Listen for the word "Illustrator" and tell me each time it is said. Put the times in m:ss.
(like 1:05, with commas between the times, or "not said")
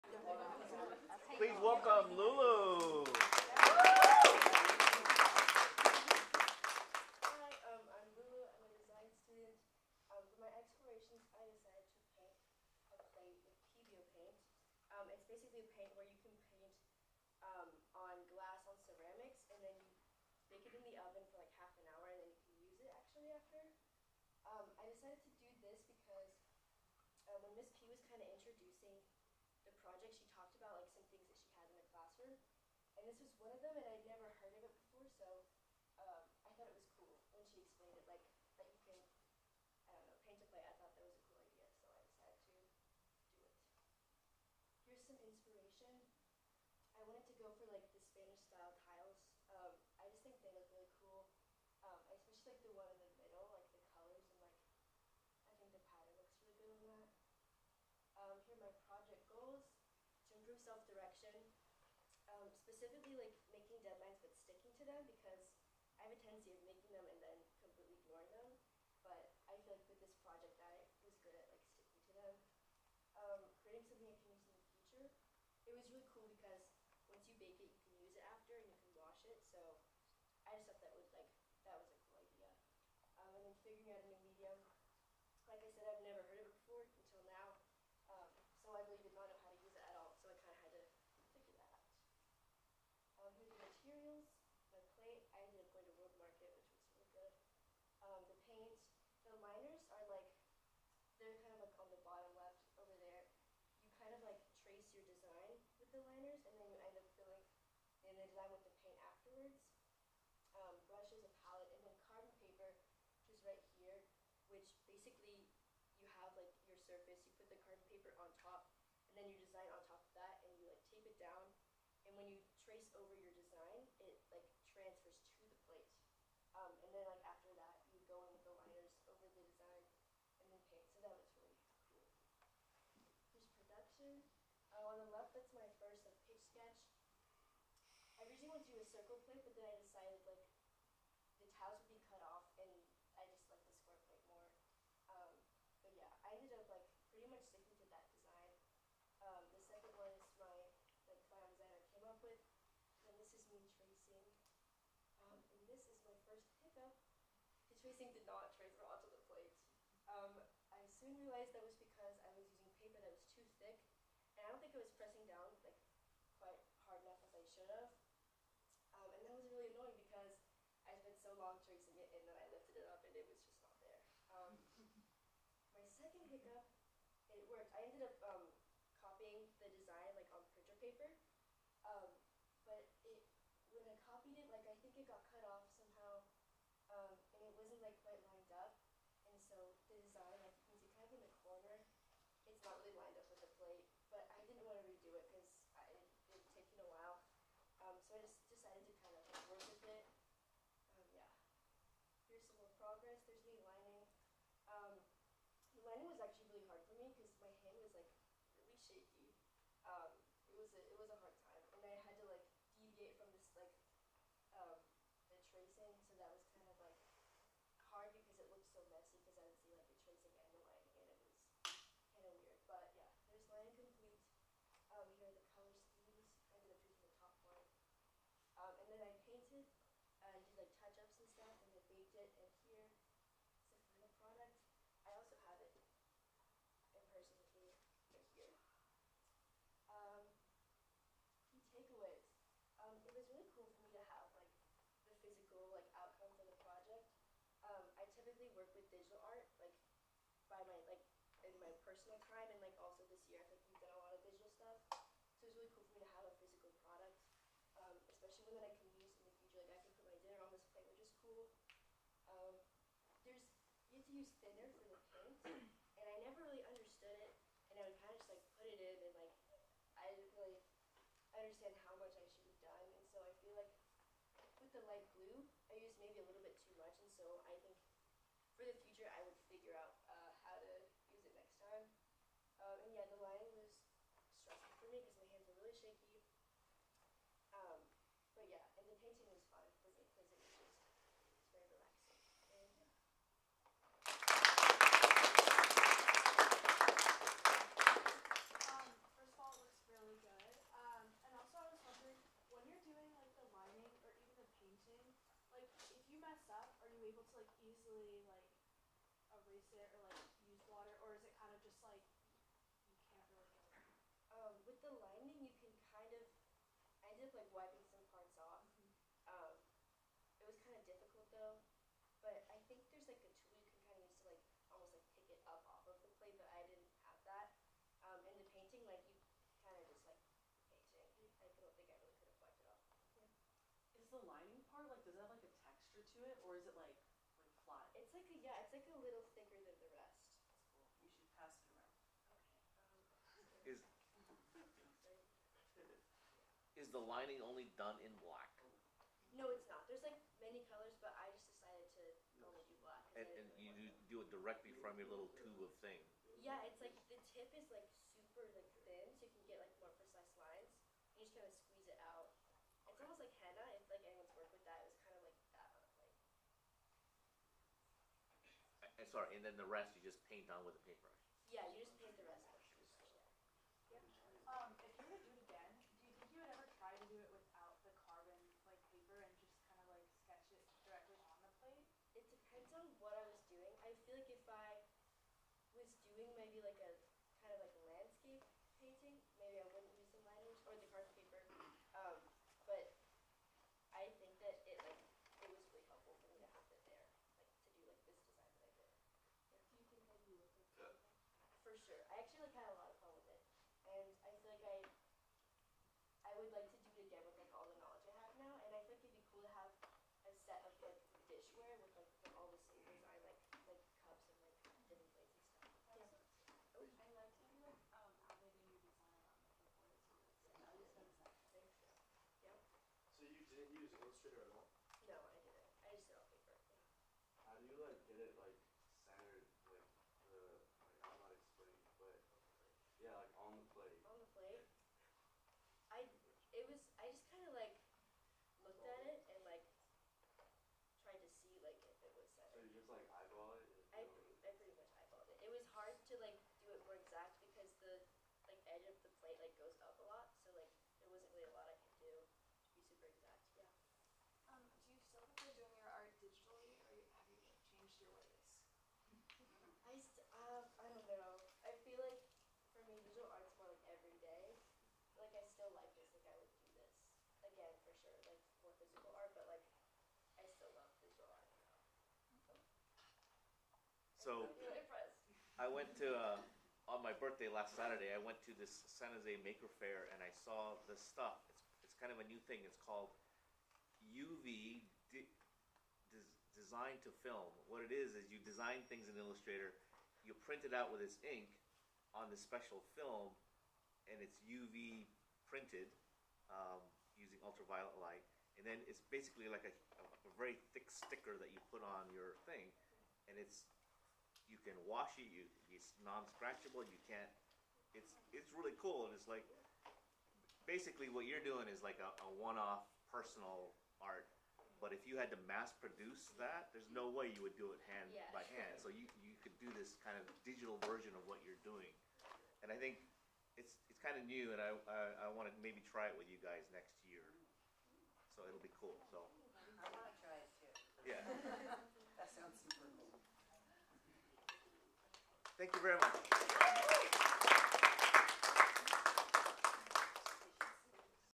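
7:03, 8:09.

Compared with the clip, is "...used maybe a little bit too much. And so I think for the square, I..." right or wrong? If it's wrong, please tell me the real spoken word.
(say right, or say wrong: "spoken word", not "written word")
wrong: "future", not "square".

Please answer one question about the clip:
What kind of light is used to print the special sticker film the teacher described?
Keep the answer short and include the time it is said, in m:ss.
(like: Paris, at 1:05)
Ultraviolet light, at 8:17.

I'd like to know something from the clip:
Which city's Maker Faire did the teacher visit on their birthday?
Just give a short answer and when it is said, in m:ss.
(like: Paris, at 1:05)
San Jose, at 7:58.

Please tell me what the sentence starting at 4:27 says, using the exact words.
And I would kind of just like put it in, and like I didn't really understand how much I should have done.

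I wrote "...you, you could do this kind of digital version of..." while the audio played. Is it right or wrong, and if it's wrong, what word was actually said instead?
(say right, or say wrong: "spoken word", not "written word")
right.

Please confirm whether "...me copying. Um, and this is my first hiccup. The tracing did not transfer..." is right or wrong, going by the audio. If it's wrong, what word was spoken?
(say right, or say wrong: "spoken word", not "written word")
wrong: "tracing", not "copying".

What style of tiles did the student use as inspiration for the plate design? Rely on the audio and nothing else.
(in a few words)
Spanish-style tiles.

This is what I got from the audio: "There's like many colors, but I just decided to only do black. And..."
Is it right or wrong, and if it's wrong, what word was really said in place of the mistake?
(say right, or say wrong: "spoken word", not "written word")
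right.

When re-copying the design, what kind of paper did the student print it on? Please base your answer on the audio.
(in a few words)
Printer paper.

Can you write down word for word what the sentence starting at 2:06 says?
Um, and then like after that, you go in with the liners over the design and then paint.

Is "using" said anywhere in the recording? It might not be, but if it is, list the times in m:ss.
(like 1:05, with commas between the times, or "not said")
8:17.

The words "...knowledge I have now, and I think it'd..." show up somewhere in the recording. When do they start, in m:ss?
6:47.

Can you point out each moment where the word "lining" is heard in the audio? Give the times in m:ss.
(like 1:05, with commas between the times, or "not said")
5:14, 5:34, 5:46.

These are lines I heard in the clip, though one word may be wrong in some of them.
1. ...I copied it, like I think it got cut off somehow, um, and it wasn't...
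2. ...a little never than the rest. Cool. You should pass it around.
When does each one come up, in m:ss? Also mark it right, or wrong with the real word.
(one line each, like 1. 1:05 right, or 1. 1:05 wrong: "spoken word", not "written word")
1. 3:03 right
2. 5:38 wrong: "thicker", not "never".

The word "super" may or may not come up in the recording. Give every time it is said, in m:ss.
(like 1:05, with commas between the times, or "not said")
5:58.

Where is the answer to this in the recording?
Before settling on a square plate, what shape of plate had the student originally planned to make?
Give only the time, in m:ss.
2:18.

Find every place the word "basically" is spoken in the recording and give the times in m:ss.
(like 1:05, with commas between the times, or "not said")
1:54, 8:19, 8:30.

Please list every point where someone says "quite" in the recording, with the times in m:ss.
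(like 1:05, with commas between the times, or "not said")
3:08.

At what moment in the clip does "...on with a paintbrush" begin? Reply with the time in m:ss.
6:10.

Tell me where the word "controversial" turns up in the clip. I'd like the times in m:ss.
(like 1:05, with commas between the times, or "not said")
not said.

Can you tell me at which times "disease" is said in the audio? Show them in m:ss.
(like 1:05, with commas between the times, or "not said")
not said.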